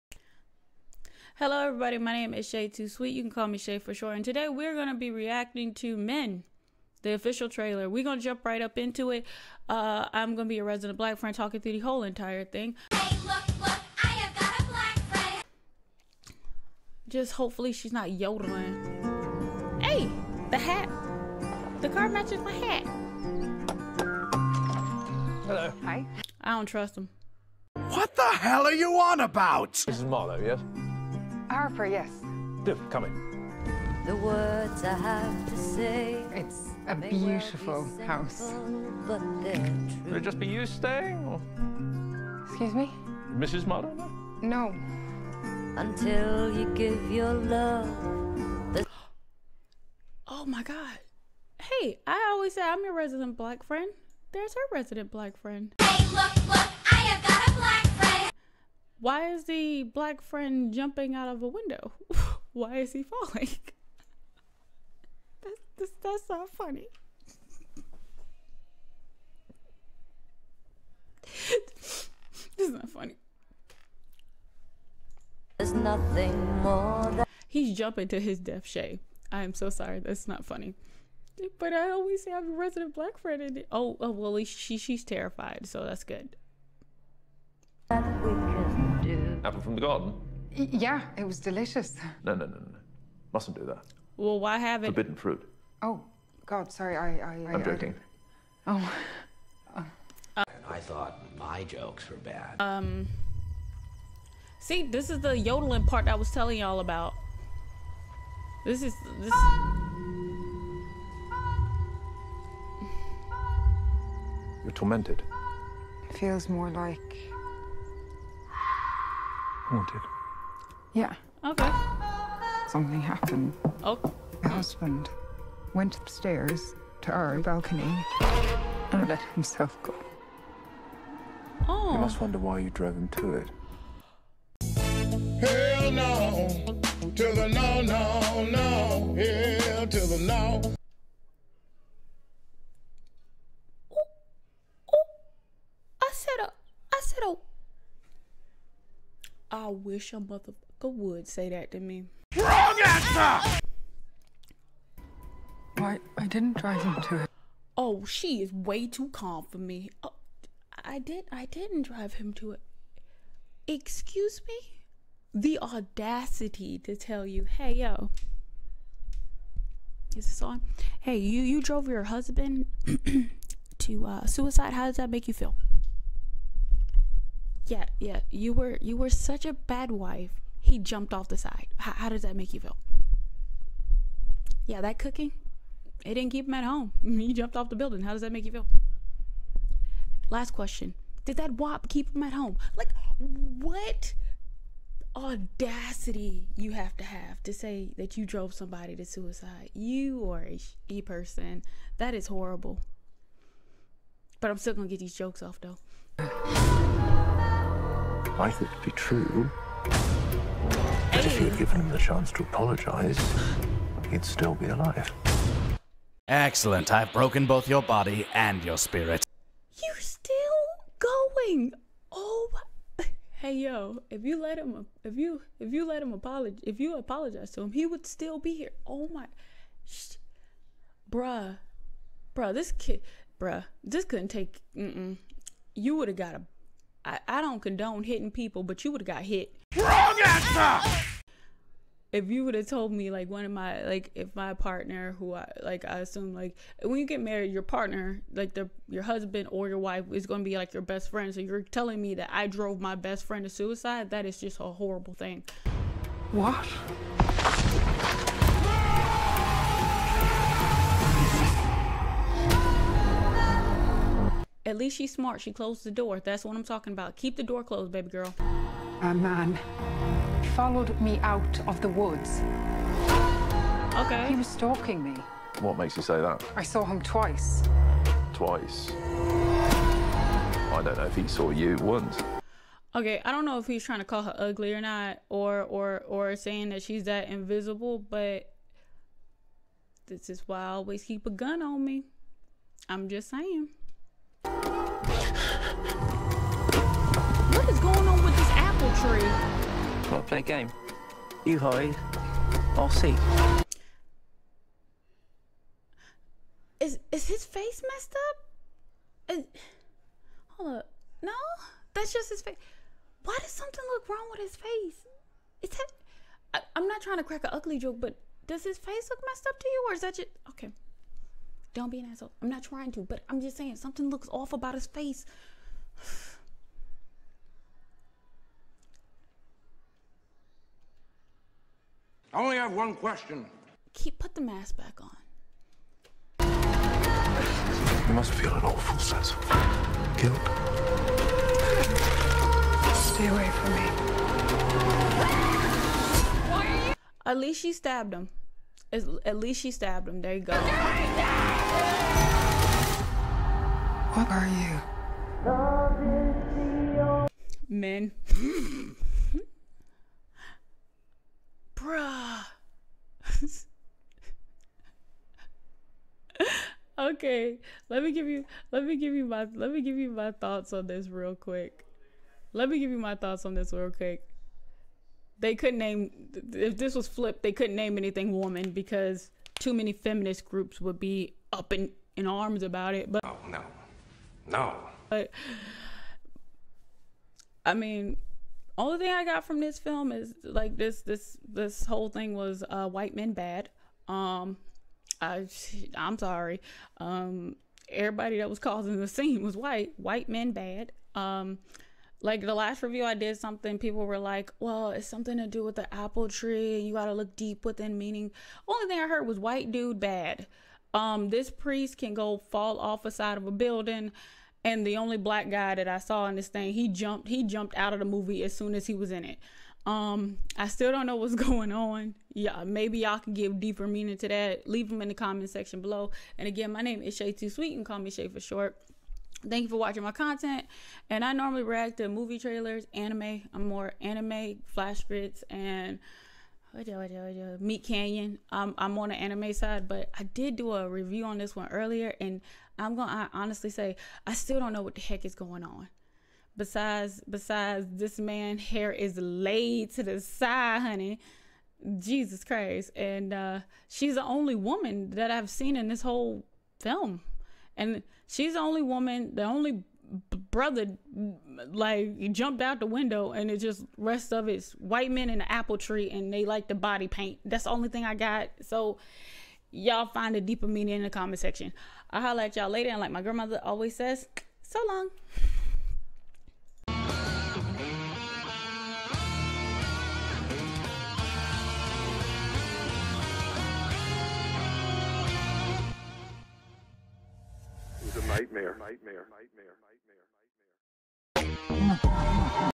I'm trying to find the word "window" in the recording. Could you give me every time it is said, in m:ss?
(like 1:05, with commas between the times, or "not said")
1:01, 7:42.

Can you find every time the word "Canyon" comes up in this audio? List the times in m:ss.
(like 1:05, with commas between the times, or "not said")
7:17.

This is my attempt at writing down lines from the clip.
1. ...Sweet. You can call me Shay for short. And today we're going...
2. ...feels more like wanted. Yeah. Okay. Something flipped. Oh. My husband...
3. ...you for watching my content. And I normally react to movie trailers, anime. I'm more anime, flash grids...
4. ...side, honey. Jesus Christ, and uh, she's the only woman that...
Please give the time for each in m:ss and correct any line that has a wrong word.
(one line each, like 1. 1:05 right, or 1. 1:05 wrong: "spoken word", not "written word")
1. 0:02 right
2. 1:56 wrong: "happened", not "flipped"
3. 7:09 right
4. 7:30 right.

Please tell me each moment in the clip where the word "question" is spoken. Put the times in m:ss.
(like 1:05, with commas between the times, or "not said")
3:10, 5:32.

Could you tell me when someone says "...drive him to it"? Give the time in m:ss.
2:41.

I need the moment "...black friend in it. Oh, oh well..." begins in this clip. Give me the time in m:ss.
1:22.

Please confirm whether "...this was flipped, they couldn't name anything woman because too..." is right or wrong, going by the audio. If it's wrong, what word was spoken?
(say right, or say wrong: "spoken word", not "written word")
right.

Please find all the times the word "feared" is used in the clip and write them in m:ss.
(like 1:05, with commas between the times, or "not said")
not said.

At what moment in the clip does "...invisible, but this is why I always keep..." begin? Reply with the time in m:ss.
4:47.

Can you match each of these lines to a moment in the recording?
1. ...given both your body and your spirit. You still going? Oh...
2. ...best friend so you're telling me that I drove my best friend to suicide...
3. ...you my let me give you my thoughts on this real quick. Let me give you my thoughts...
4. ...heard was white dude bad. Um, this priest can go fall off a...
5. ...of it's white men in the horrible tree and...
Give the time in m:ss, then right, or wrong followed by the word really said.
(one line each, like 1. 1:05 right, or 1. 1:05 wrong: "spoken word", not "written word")
1. 3:37 wrong: "broken", not "given"
2. 4:10 right
3. 6:09 right
4. 6:49 right
5. 7:44 wrong: "apple", not "horrible".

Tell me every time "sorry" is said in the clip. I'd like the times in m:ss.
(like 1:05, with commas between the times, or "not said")
1:19, 1:36, 6:36.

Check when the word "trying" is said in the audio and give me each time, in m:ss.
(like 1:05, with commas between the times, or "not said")
4:43, 5:17, 5:22.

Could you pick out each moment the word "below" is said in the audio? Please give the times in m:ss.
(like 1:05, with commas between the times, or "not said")
7:05.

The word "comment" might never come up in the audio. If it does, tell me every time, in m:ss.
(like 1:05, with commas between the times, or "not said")
7:05, 7:51.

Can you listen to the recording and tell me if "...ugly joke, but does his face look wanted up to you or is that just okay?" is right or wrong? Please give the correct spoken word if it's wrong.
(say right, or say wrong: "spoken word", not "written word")
wrong: "messed", not "wanted".